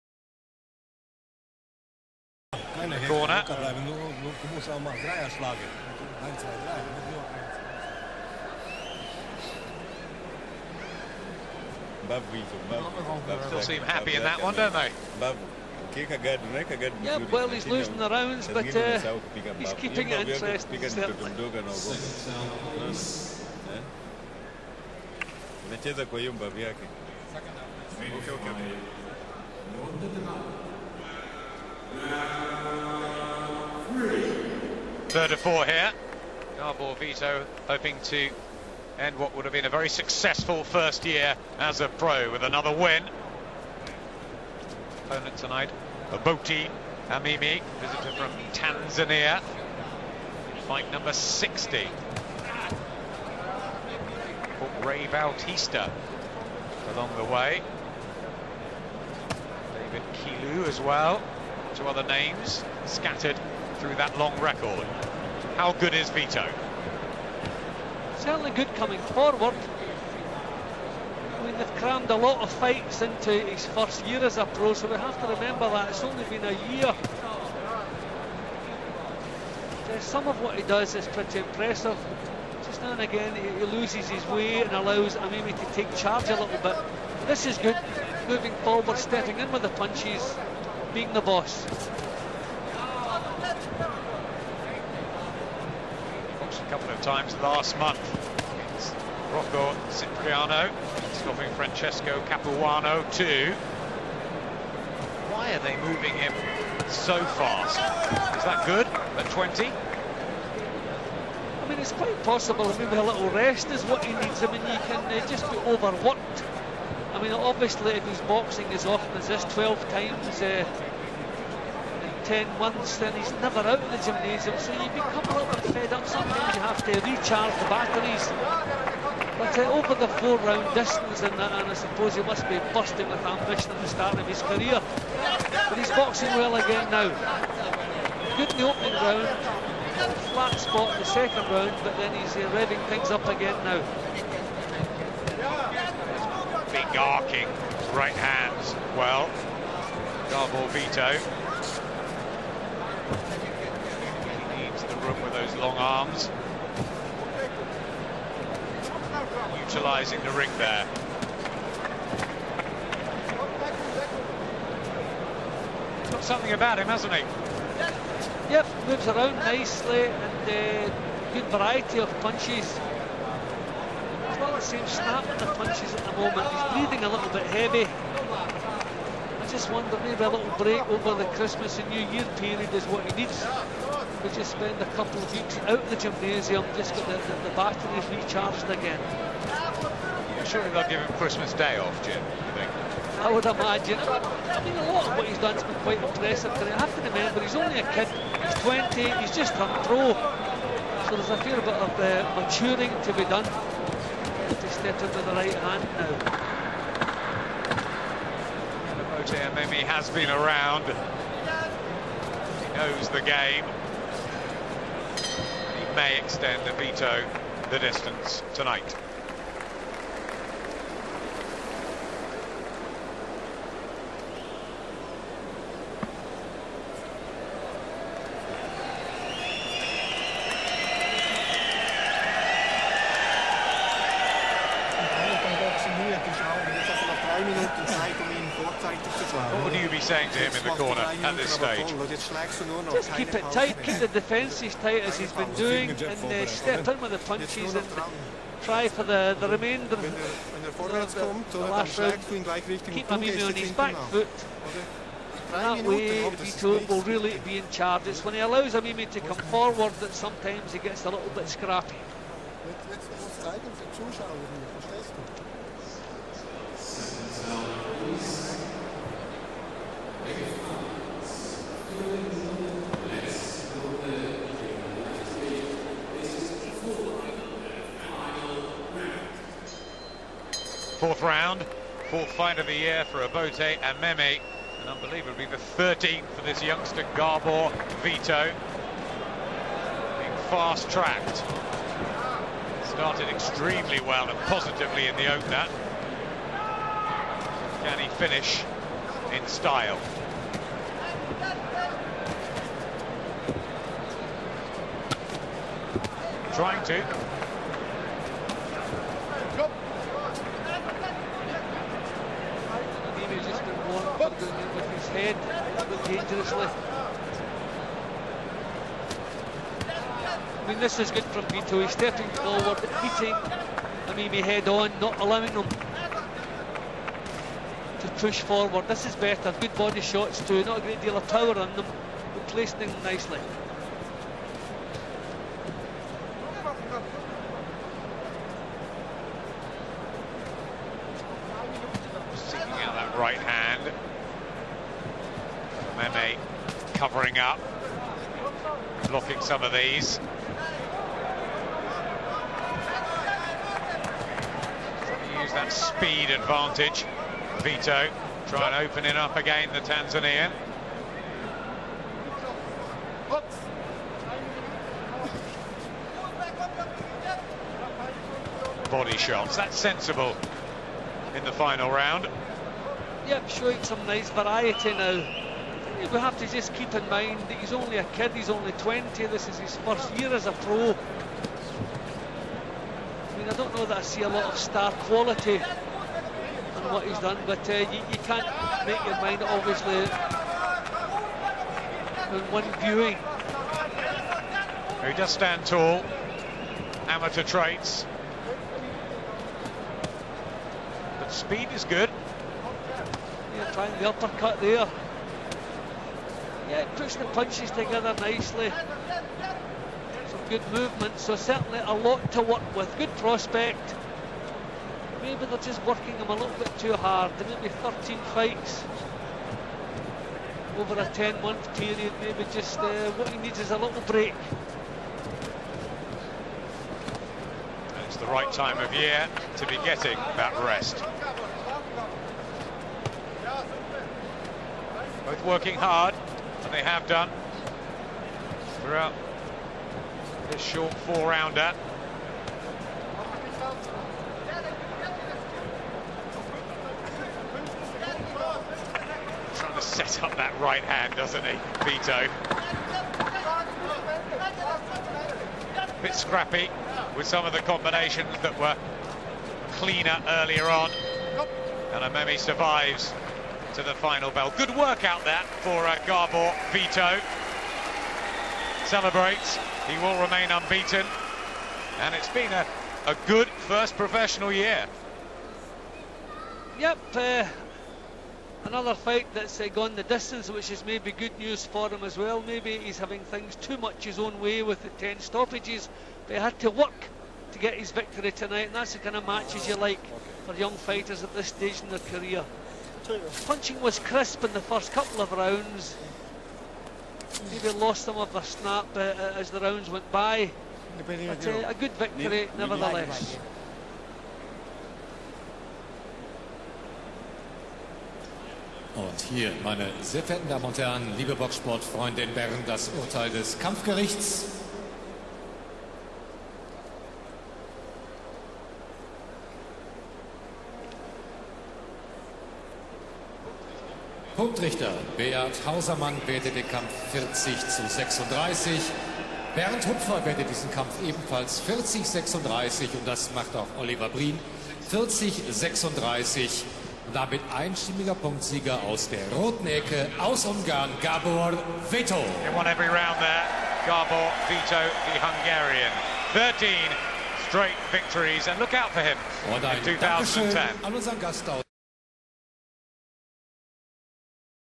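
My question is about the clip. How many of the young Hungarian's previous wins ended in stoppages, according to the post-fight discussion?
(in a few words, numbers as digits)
10.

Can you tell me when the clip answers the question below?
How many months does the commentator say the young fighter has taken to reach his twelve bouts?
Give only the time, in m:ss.
2:02.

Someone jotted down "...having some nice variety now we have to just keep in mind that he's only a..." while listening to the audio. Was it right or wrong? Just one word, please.
wrong.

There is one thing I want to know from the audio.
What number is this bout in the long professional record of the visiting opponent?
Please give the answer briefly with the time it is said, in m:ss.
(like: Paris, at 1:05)
60, at 0:51.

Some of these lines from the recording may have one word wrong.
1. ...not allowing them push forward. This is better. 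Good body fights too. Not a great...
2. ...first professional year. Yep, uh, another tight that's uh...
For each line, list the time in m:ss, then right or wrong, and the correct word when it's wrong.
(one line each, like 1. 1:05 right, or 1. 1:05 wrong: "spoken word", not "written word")
1. 5:24 wrong: "shots", not "fights"
2. 7:53 wrong: "fight", not "tight".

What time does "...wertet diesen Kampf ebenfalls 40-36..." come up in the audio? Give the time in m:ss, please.
8:50.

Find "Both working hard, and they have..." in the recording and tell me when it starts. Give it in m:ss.
7:15.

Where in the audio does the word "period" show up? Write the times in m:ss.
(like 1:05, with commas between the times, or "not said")
3:02, 7:01.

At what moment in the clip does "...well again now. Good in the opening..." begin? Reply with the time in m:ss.
2:16.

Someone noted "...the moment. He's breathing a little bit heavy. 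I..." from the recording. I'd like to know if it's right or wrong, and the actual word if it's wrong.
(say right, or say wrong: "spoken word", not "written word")
right.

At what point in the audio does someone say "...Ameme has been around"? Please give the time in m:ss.
3:29.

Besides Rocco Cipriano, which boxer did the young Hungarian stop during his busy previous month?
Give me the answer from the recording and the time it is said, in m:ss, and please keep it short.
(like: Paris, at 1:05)
Francesco Capuano, at 1:41.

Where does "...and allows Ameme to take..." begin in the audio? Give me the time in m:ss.
1:24.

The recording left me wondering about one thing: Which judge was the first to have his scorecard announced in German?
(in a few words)
Beat Hausermann.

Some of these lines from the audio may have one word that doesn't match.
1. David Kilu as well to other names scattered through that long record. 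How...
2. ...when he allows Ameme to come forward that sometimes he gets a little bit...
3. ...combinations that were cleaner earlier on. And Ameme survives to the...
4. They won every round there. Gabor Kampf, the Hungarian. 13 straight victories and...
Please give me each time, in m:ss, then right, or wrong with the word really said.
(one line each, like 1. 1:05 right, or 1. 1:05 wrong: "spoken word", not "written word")
1. 0:59 right
2. 4:18 right
3. 7:37 right
4. 9:02 wrong: "Vito", not "Kampf".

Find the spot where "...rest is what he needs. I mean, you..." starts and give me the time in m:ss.
1:53.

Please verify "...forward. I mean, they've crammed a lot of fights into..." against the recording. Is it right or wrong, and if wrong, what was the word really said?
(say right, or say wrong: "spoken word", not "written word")
right.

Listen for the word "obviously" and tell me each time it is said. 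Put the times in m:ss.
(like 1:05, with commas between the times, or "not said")
1:57, 6:29.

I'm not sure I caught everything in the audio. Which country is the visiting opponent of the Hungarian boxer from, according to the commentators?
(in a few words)
Tanzania.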